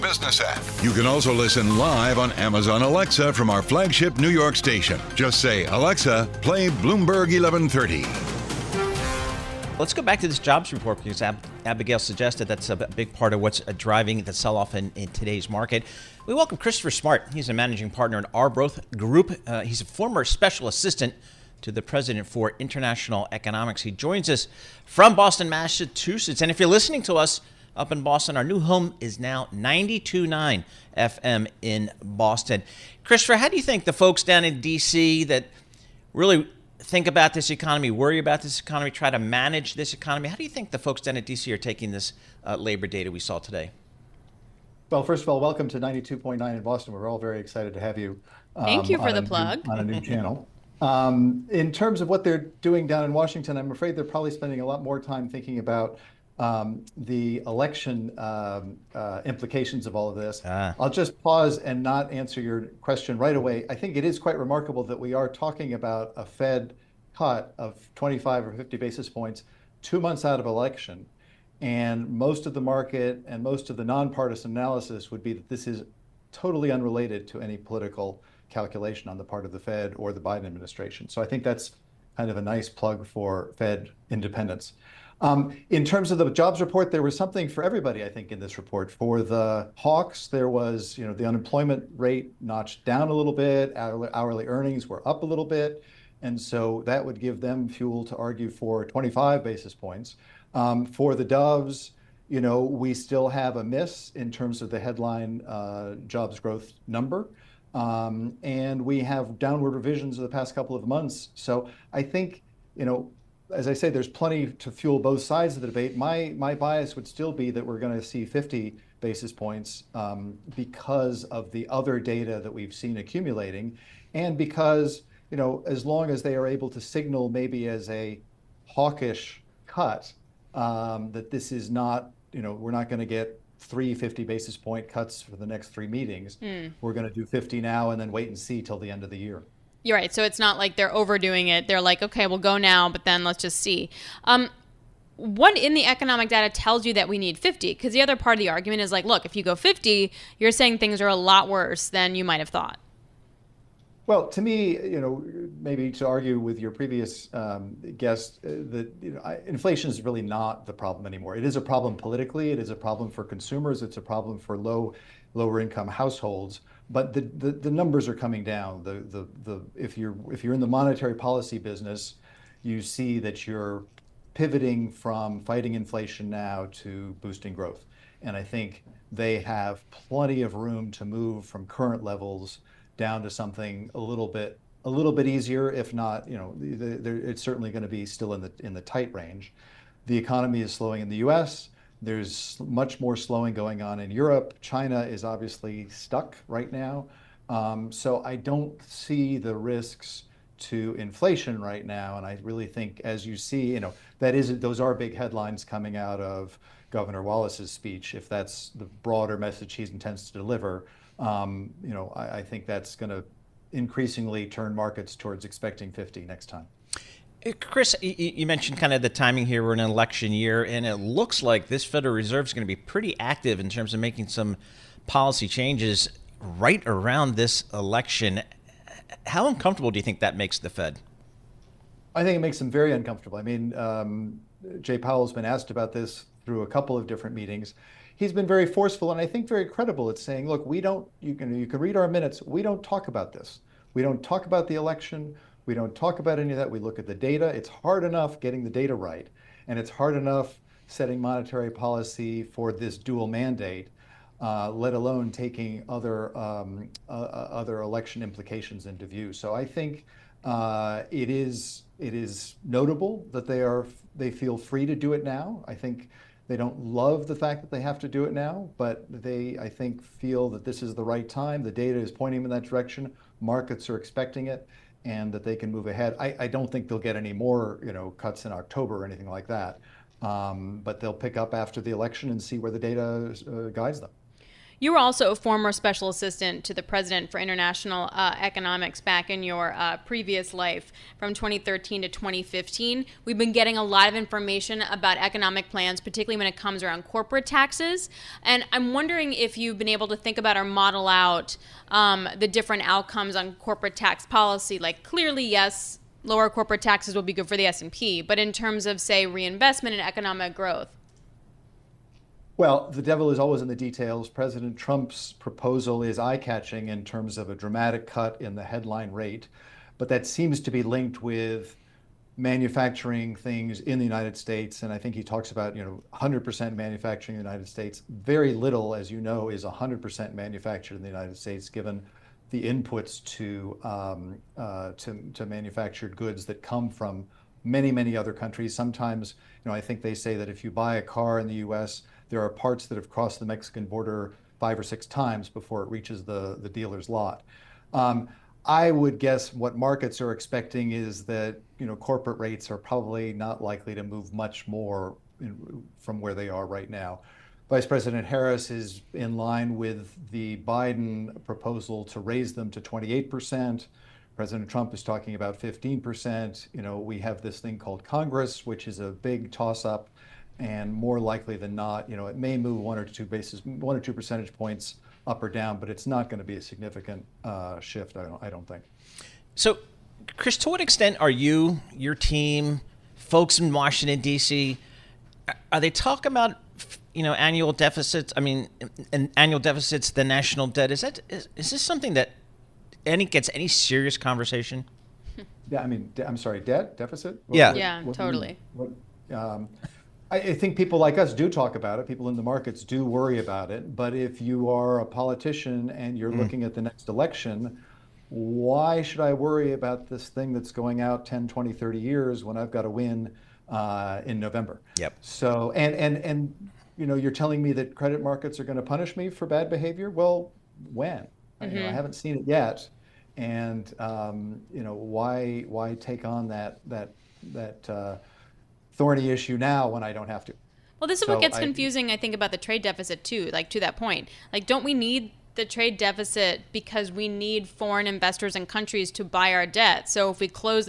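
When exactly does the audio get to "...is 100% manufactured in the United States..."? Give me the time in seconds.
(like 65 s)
329 s.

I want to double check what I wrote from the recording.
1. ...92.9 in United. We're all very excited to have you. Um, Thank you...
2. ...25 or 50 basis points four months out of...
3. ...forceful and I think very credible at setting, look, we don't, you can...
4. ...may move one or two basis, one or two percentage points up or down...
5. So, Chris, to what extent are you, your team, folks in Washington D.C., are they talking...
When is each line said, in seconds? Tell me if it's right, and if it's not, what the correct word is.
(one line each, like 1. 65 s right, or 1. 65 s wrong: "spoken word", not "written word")
1. 45 s wrong: "Boston", not "United"
2. 67 s wrong: "two", not "four"
3. 238 s wrong: "saying", not "setting"
4. 372 s right
5. 379 s right.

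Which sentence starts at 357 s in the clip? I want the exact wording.
Vice President Harris is in line with the Biden proposal to raise them to 28 percent.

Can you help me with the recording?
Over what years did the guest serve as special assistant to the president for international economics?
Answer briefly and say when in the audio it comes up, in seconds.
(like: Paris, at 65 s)
2013 to 2015, at 291 s.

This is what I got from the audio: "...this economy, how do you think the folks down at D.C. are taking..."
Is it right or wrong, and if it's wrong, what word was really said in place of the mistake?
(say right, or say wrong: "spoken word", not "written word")
right.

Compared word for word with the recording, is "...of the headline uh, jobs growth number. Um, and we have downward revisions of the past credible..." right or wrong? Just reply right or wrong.
wrong.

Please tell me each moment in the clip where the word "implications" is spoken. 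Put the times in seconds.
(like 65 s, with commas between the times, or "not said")
59 s, 258 s.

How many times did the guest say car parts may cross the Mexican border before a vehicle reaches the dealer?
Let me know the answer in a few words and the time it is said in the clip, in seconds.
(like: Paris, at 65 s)
5 or 6 times, at 344 s.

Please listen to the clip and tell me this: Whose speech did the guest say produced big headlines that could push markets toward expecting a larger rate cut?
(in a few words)
Governor Wallace.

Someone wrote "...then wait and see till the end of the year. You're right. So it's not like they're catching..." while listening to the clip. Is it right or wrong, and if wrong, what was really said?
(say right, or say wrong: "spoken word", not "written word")
wrong: "overdoing", not "catching".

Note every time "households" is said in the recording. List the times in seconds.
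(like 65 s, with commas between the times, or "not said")
165 s.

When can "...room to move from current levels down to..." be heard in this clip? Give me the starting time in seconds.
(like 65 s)
180 s.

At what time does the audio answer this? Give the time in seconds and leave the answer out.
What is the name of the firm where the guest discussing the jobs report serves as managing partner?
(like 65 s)
18 s.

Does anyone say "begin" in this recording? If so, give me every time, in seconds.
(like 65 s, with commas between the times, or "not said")
not said.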